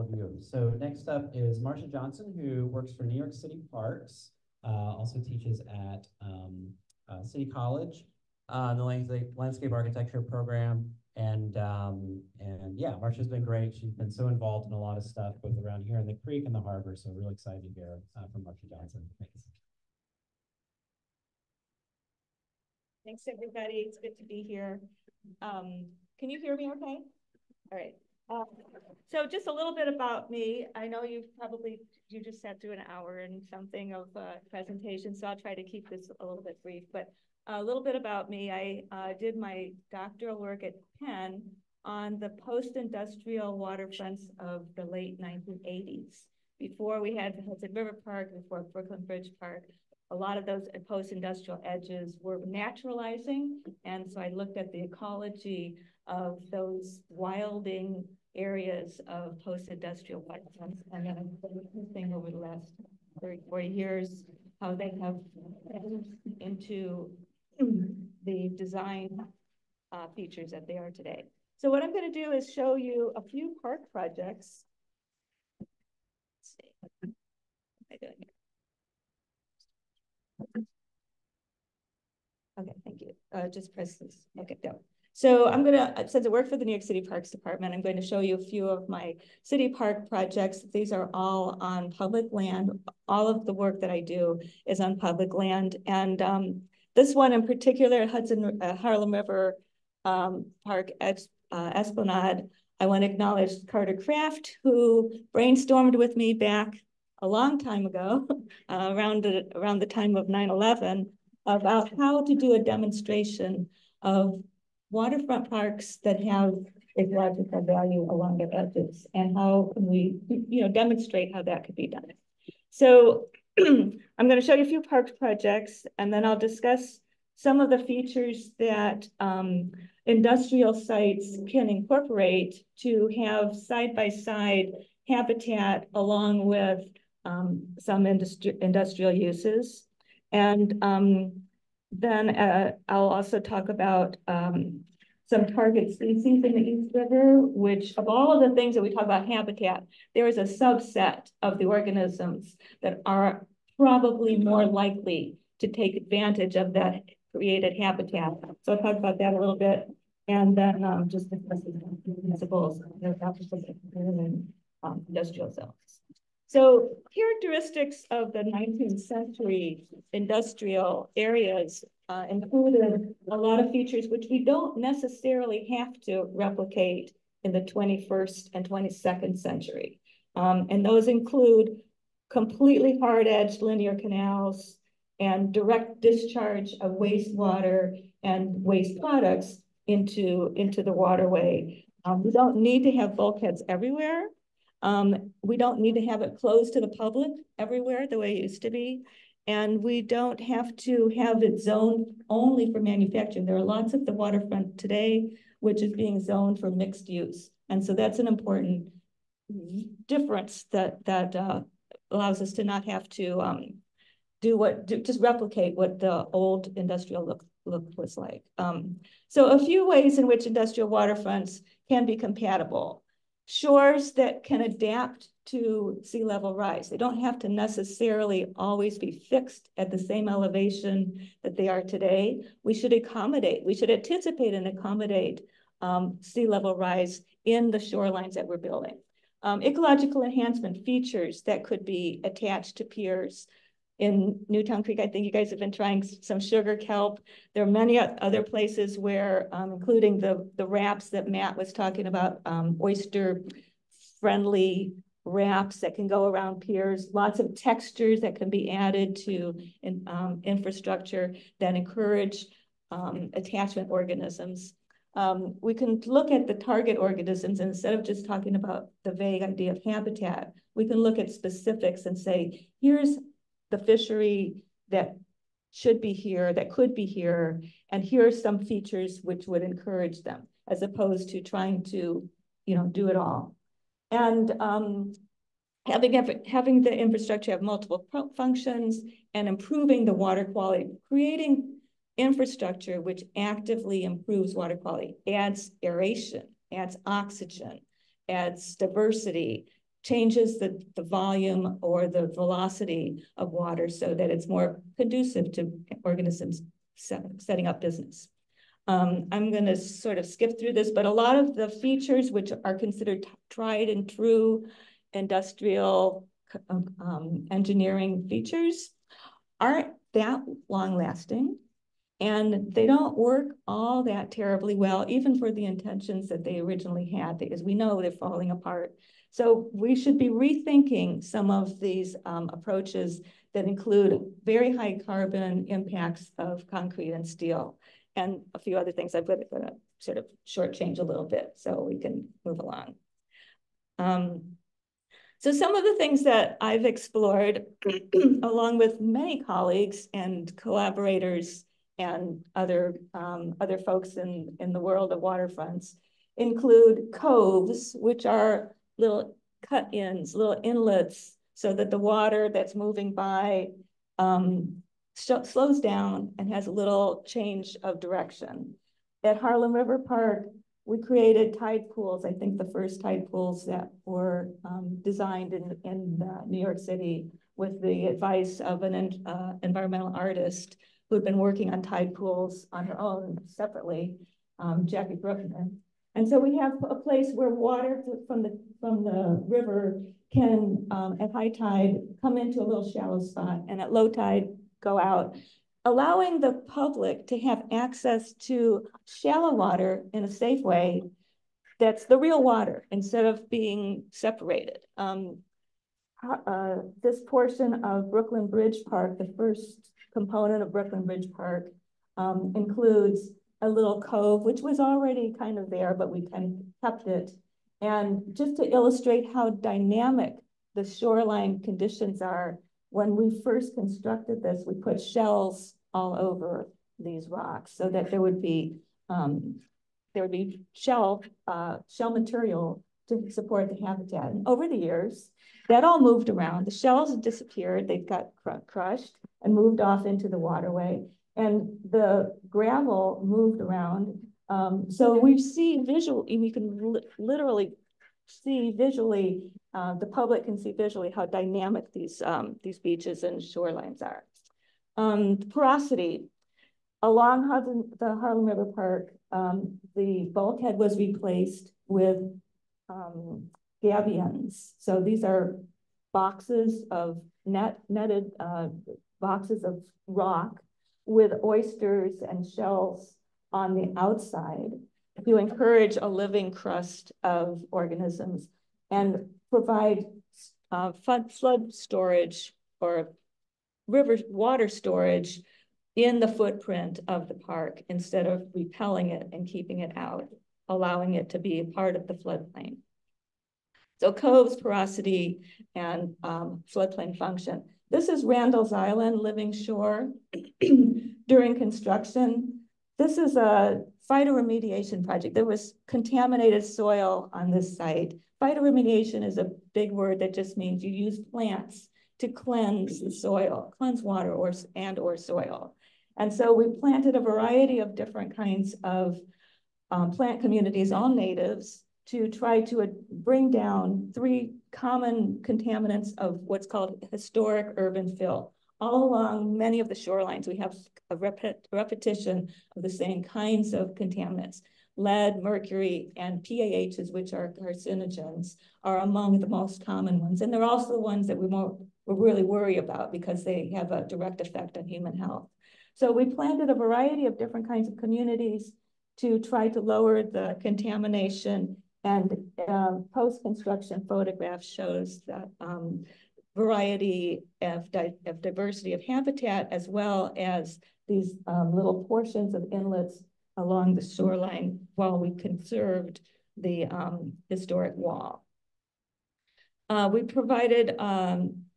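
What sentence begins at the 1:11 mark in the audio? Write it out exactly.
So what I'm going to do is show you a few park projects.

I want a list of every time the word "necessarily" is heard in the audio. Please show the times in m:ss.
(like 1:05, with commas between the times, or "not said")
2:54, 3:47.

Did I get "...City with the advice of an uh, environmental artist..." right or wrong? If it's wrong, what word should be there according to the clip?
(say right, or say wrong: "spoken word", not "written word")
right.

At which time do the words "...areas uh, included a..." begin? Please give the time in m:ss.
2:51.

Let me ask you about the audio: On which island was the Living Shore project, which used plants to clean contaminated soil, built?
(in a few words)
Randall's Island.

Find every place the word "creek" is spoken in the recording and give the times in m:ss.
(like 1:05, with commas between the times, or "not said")
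0:16, 4:04.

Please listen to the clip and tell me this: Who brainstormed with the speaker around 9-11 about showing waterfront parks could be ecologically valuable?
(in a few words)
Carter Kraft.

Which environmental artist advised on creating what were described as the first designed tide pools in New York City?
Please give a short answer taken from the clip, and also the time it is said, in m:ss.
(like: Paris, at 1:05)
Jackie Brookner, at 6:24.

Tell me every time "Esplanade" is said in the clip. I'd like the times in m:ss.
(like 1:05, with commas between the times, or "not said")
1:41.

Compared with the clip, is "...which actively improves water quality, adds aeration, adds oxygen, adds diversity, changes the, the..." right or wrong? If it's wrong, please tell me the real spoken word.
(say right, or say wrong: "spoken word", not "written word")
right.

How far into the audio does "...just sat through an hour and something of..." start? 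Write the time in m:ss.
0:32.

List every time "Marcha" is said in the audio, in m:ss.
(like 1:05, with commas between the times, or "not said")
0:01, 0:13, 0:18.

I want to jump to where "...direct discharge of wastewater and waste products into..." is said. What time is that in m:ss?
3:05.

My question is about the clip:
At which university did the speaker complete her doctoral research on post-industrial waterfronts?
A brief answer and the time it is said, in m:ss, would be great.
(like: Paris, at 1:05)
Penn, at 0:41.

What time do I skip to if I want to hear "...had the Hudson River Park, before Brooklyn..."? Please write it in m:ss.
0:47.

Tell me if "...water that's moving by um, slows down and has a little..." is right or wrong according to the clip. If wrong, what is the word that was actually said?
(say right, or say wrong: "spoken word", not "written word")
right.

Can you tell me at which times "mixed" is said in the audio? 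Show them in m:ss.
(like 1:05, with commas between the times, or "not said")
3:26.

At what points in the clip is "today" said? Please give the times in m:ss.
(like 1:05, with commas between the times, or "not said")
1:10, 3:24, 3:51.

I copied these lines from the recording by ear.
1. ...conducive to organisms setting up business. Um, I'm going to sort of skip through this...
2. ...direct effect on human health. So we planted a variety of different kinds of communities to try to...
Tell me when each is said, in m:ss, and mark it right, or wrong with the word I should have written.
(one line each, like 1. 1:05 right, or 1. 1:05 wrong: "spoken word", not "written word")
1. 5:04 right
2. 9:04 right.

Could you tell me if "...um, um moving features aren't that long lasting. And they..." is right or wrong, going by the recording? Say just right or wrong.
wrong.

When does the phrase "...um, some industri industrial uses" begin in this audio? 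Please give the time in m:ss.
2:17.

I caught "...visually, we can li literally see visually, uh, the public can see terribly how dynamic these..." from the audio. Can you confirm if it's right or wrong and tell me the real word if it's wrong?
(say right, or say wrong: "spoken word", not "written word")
wrong: "visually", not "terribly".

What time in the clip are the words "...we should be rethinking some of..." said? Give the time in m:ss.
5:29.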